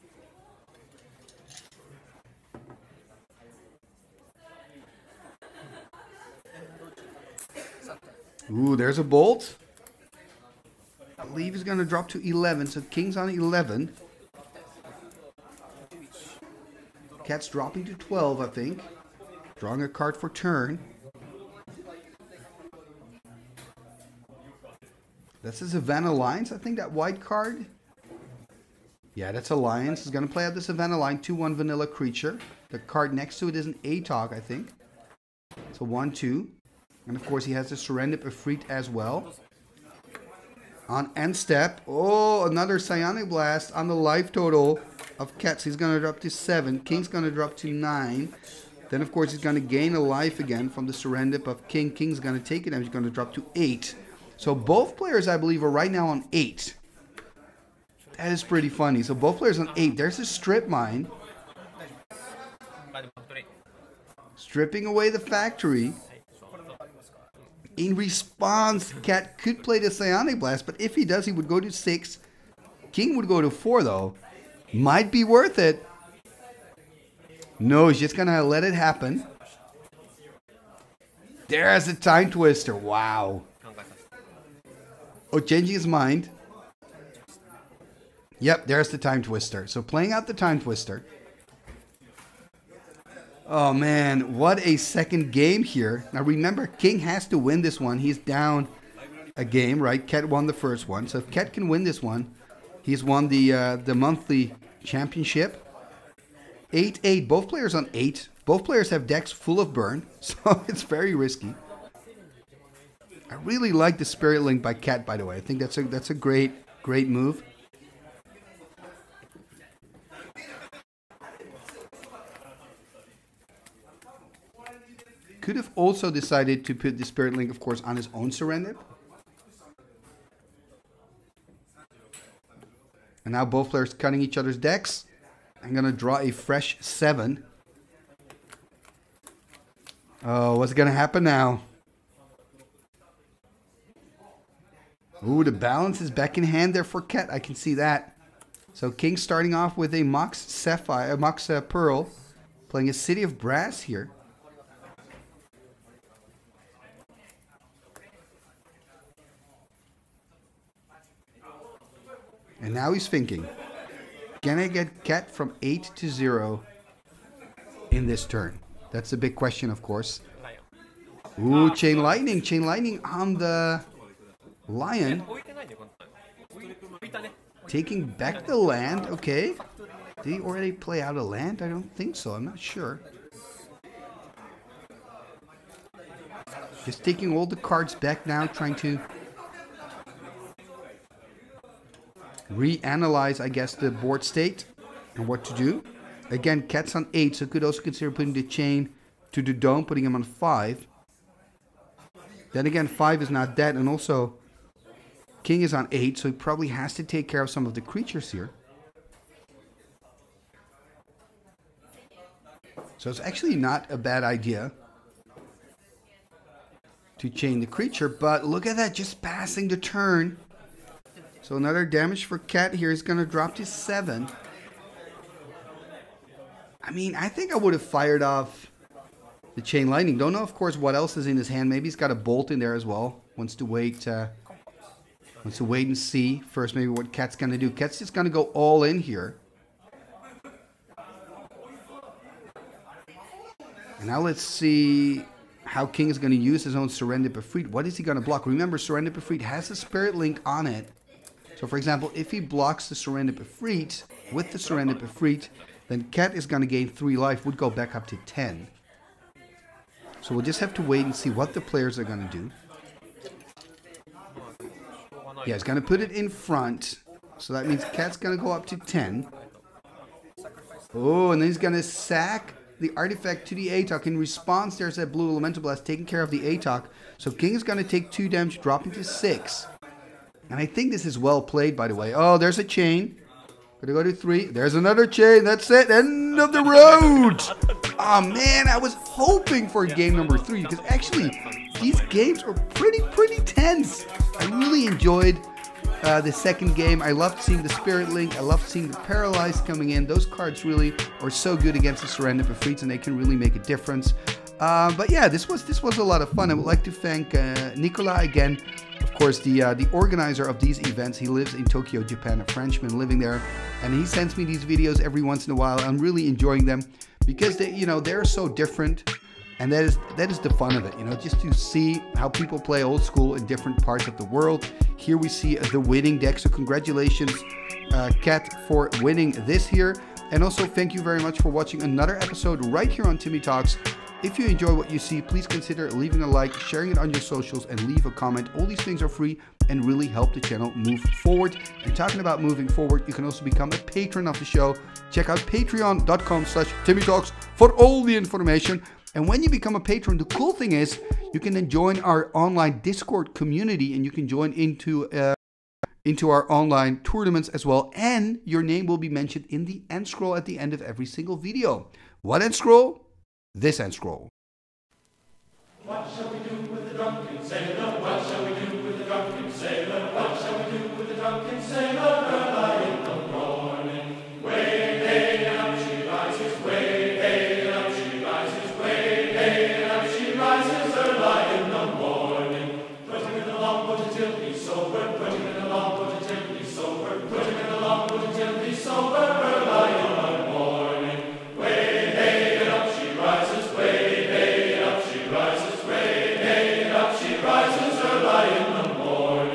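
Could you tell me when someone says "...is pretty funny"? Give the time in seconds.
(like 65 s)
58 s.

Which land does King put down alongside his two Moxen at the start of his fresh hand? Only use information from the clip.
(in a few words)
City of Brass.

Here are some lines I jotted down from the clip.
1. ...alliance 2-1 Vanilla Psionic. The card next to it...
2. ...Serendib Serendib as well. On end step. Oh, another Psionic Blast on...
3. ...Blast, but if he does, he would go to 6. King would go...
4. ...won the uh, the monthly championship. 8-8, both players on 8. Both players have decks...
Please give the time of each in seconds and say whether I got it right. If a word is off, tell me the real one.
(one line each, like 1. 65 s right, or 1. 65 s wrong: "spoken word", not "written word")
1. 30 s wrong: "Creature", not "Psionic"
2. 37 s wrong: "Efreet", not "Serendib"
3. 70 s right
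4. 103 s right.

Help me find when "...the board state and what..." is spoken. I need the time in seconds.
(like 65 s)
193 s.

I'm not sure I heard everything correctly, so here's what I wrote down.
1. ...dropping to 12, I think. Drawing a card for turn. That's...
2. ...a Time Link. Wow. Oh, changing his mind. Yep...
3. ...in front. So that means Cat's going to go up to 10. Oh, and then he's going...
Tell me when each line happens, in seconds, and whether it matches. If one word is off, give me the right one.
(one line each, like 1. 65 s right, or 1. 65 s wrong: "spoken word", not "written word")
1. 17 s right
2. 81 s wrong: "Twister", not "Link"
3. 266 s right.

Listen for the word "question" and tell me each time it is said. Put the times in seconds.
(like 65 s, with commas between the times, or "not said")
169 s.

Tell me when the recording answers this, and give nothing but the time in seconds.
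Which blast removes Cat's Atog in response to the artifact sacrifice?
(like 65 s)
275 s.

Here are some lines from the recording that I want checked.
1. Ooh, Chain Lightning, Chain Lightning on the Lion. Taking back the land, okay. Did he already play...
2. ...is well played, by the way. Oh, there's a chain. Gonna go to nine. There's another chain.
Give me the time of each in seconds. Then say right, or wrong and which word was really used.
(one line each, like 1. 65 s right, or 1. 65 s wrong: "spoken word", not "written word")
1. 171 s right
2. 281 s wrong: "three", not "nine".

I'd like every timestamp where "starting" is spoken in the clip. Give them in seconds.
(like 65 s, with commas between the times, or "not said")
149 s.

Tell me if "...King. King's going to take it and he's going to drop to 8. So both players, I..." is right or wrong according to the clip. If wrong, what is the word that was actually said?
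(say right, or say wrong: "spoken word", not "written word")
right.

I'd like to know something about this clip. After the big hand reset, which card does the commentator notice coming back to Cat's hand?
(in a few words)
Balance.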